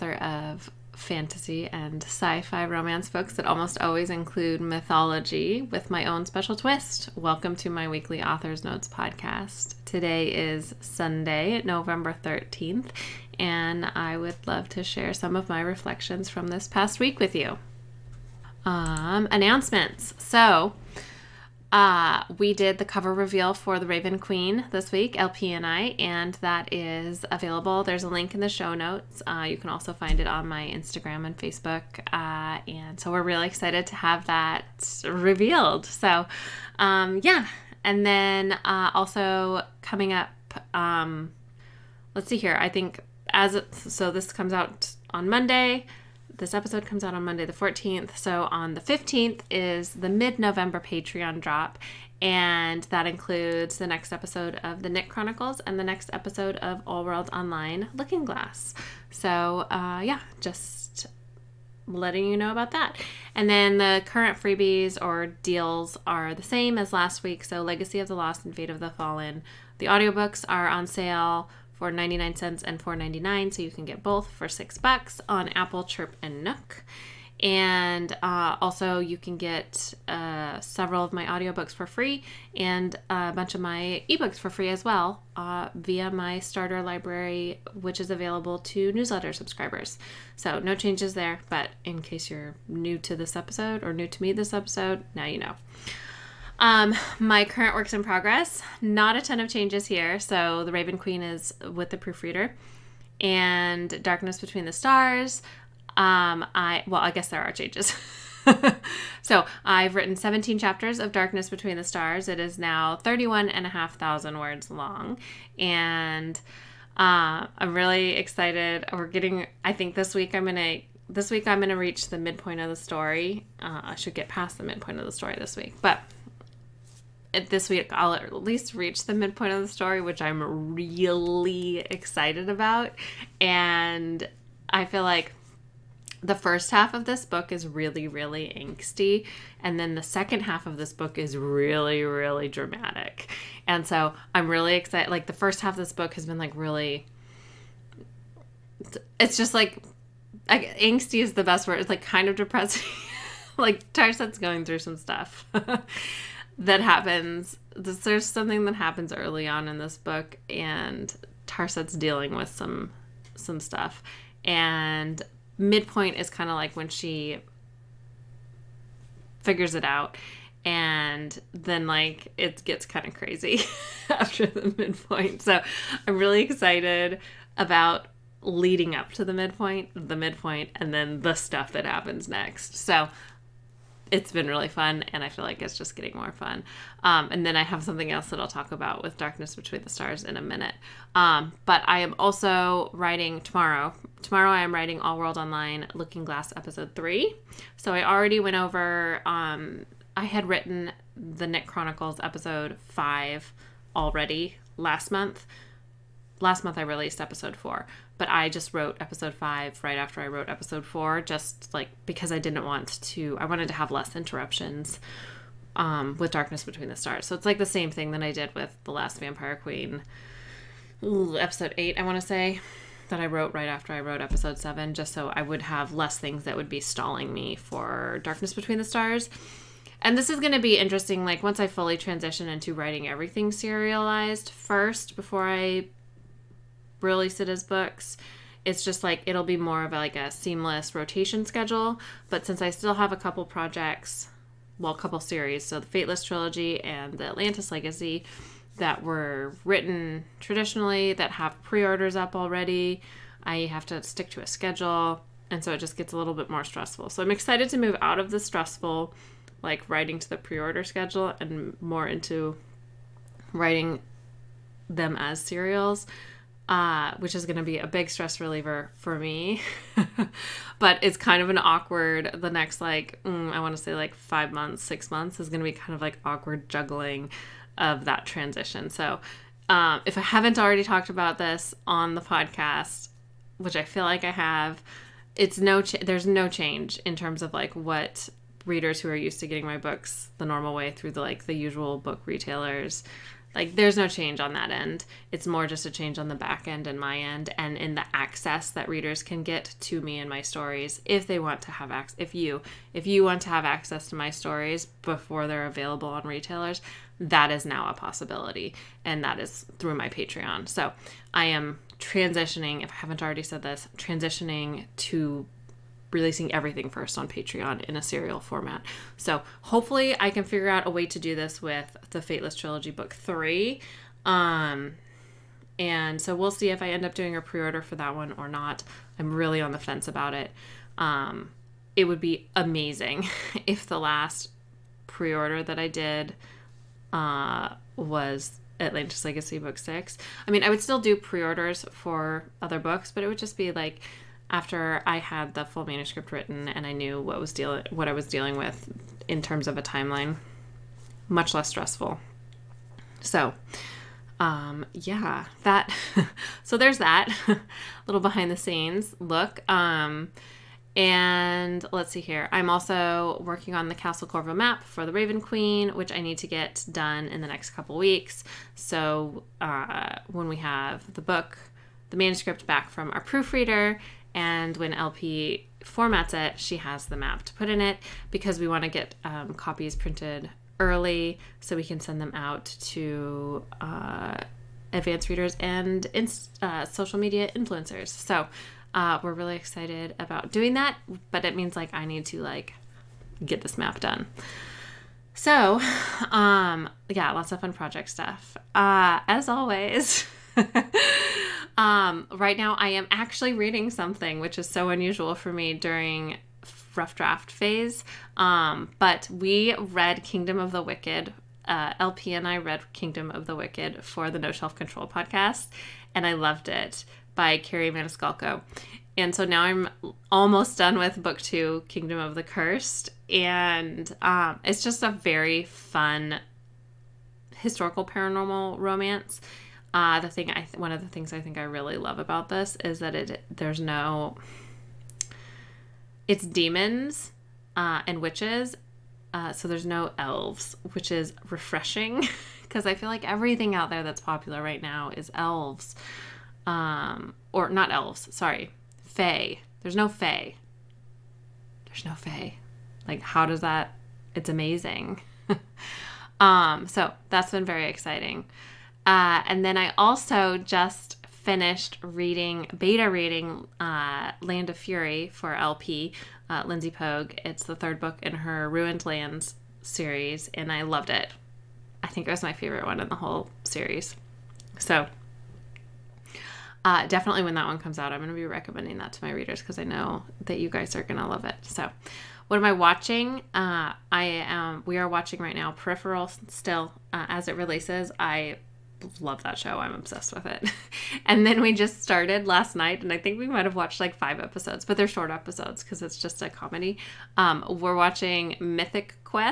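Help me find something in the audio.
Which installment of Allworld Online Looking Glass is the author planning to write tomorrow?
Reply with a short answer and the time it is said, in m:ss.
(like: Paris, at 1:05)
Episode 3, at 3:16.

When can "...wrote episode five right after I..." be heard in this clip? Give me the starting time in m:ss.
3:28.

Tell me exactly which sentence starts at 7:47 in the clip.
It's the third book in her Ruined Lands series, and I loved it.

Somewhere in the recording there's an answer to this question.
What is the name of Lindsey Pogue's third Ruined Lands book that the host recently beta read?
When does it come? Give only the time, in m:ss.
7:44.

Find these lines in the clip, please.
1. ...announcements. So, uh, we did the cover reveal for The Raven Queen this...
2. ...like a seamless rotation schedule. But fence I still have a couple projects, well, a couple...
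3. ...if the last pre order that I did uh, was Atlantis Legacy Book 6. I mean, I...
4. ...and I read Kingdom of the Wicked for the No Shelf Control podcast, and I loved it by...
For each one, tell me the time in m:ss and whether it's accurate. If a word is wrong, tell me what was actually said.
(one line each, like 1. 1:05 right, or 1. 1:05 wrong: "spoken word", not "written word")
1. 0:19 right
2. 3:59 wrong: "since", not "fence"
3. 5:33 right
4. 6:52 right.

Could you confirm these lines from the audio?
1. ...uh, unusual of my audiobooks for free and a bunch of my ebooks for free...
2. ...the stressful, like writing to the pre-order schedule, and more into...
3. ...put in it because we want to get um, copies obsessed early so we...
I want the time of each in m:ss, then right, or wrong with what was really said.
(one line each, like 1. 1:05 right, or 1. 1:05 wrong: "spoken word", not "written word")
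1. 1:20 wrong: "several", not "unusual"
2. 4:18 right
3. 6:17 wrong: "printed", not "obsessed".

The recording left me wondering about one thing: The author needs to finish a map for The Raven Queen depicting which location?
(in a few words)
Castle Corvo.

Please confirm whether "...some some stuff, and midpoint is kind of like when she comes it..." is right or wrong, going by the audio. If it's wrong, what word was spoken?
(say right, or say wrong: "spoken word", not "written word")
wrong: "figures", not "comes".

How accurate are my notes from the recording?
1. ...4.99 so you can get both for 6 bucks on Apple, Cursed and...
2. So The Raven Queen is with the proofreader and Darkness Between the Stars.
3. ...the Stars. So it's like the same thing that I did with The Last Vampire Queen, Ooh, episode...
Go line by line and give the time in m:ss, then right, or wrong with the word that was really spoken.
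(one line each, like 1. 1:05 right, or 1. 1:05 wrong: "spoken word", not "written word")
1. 1:12 wrong: "Chirp", not "Cursed"
2. 1:40 right
3. 3:36 right.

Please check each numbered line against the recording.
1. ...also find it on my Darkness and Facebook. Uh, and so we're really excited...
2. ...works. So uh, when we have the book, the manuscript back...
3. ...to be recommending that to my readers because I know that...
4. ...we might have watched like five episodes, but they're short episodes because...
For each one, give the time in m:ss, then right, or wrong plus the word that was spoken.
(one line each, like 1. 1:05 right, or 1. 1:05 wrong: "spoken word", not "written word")
1. 0:29 wrong: "Instagram", not "Darkness"
2. 6:07 wrong: "weeks", not "works"
3. 7:58 right
4. 8:13 right.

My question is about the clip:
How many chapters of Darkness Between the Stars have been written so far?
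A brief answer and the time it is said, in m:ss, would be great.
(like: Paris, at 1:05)
17, at 1:50.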